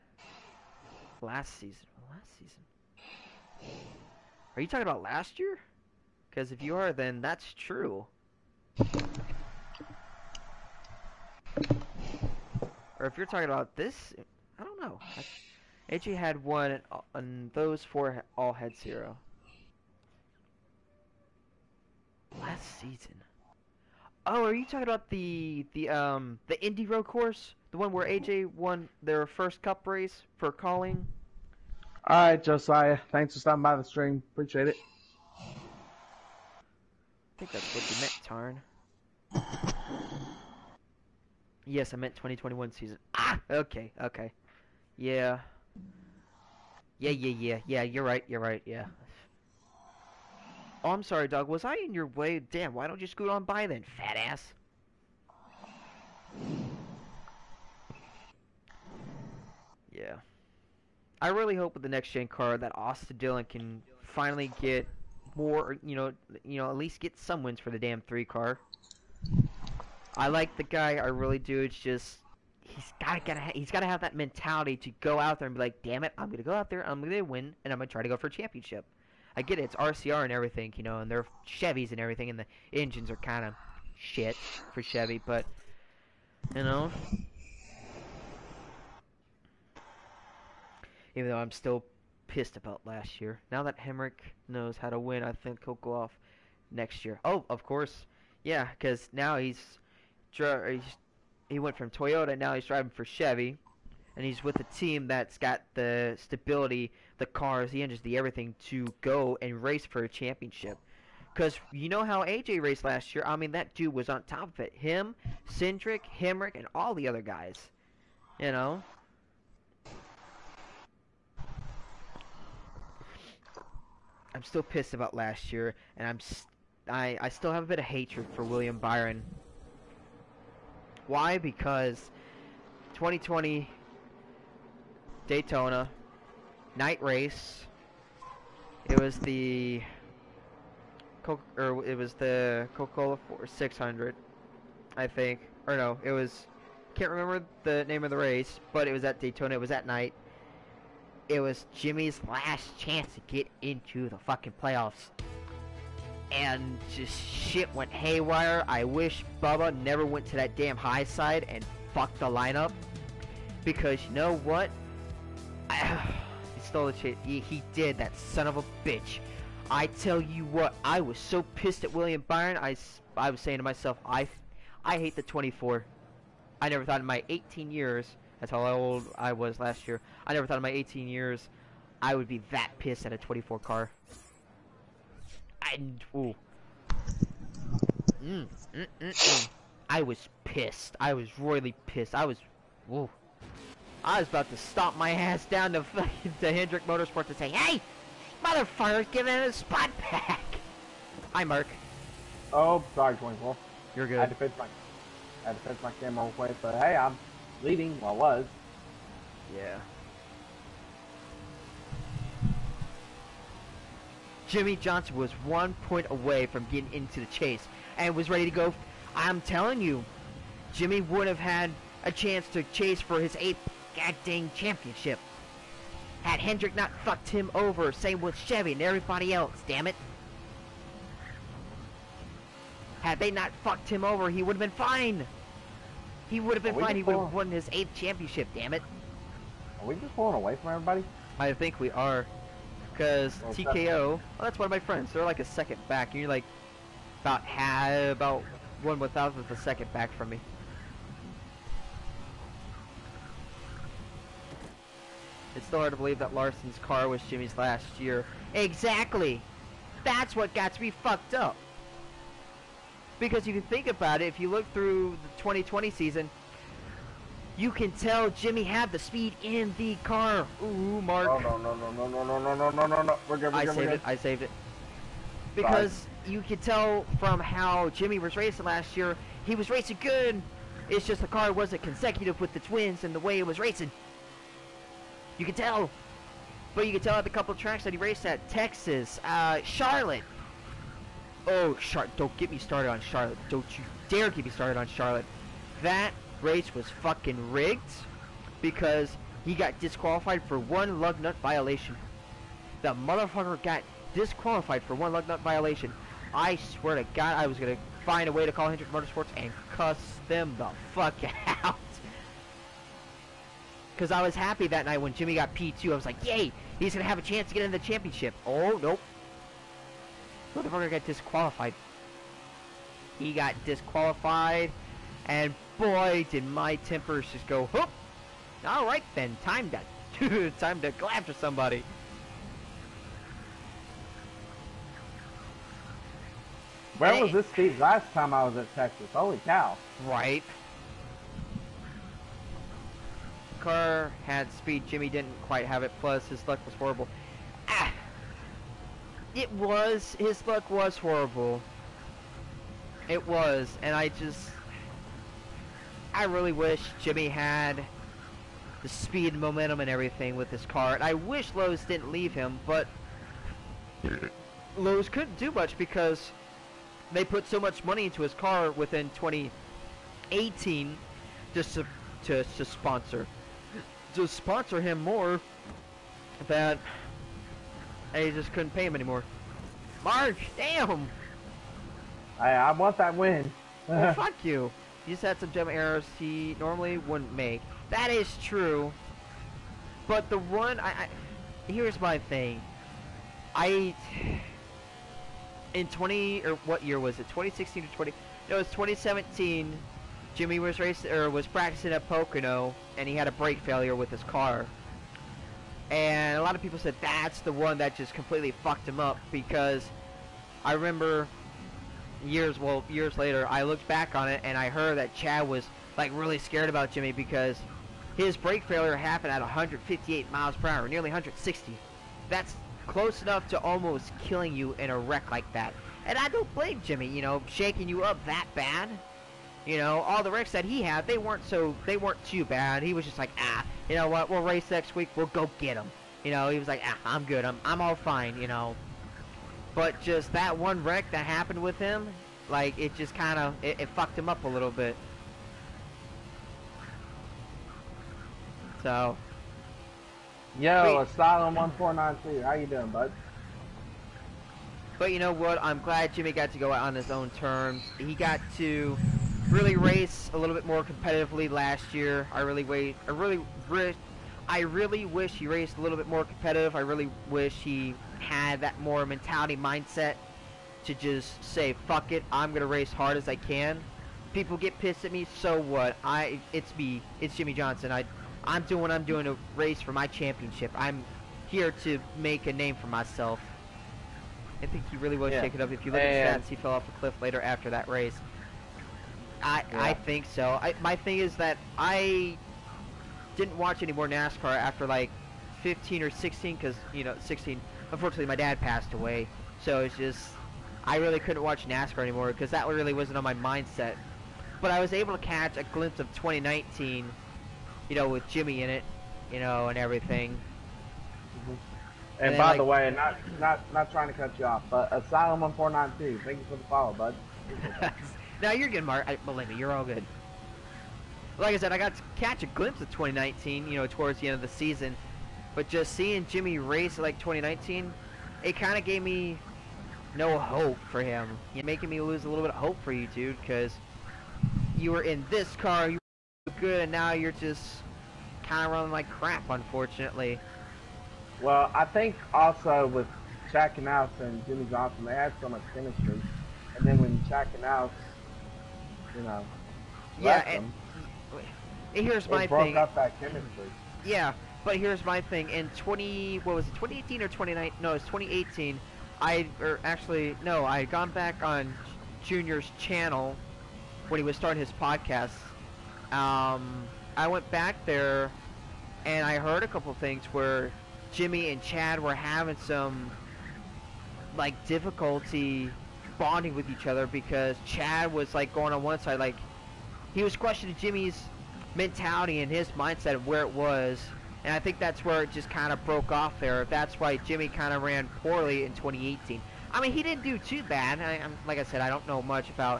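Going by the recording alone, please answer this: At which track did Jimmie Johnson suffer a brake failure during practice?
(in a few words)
Pocono.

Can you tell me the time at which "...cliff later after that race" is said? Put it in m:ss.
8:06.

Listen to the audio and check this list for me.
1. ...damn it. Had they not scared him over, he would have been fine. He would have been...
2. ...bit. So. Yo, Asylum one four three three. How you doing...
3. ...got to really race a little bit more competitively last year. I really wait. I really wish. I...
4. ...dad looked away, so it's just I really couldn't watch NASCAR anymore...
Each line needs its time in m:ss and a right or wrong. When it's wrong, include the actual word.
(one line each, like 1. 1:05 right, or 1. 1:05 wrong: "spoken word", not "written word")
1. 3:49 wrong: "fucked", not "scared"
2. 7:24 wrong: "nine", not "three"
3. 7:38 right
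4. 8:18 wrong: "passed", not "looked".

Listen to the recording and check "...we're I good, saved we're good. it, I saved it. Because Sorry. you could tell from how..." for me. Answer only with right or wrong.
right.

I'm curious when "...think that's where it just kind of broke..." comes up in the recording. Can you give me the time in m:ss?
9:44.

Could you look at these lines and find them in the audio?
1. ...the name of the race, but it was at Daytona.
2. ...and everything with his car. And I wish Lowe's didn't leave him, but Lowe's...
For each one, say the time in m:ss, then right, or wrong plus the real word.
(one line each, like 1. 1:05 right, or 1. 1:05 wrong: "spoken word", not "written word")
1. 2:27 right
2. 5:59 right.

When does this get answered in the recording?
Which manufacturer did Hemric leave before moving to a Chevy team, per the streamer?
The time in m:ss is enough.
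1:41.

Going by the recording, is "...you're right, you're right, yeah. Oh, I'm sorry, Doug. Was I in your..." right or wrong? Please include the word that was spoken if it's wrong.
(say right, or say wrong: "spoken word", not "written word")
right.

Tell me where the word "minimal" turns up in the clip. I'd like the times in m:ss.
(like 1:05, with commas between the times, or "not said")
not said.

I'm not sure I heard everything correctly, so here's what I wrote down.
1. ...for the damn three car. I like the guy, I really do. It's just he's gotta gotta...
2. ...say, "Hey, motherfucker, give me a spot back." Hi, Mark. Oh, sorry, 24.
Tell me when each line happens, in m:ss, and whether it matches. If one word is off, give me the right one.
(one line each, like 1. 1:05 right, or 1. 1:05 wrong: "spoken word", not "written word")
1. 1:07 right
2. 3:17 right.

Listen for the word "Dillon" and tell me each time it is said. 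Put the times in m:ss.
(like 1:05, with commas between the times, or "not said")
1:03.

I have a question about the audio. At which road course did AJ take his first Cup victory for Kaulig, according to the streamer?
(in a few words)
Indy Road course.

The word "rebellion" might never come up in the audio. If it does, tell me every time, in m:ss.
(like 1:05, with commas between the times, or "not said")
not said.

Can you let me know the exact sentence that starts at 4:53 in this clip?
Don't you dare get me started on Charlotte.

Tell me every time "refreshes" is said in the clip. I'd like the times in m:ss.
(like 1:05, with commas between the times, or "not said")
not said.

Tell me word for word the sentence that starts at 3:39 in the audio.
I'm telling you, Jimmy would have had a chance to chase for his eighth goddamn championship.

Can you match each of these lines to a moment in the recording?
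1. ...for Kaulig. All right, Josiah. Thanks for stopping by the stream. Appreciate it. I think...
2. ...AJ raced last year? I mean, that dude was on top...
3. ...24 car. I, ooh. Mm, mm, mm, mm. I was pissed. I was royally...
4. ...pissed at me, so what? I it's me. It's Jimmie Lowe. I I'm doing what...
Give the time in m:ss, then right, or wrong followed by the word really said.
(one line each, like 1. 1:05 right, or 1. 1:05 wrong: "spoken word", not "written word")
1. 0:30 right
2. 1:52 right
3. 3:03 right
4. 7:54 wrong: "Johnson", not "Lowe".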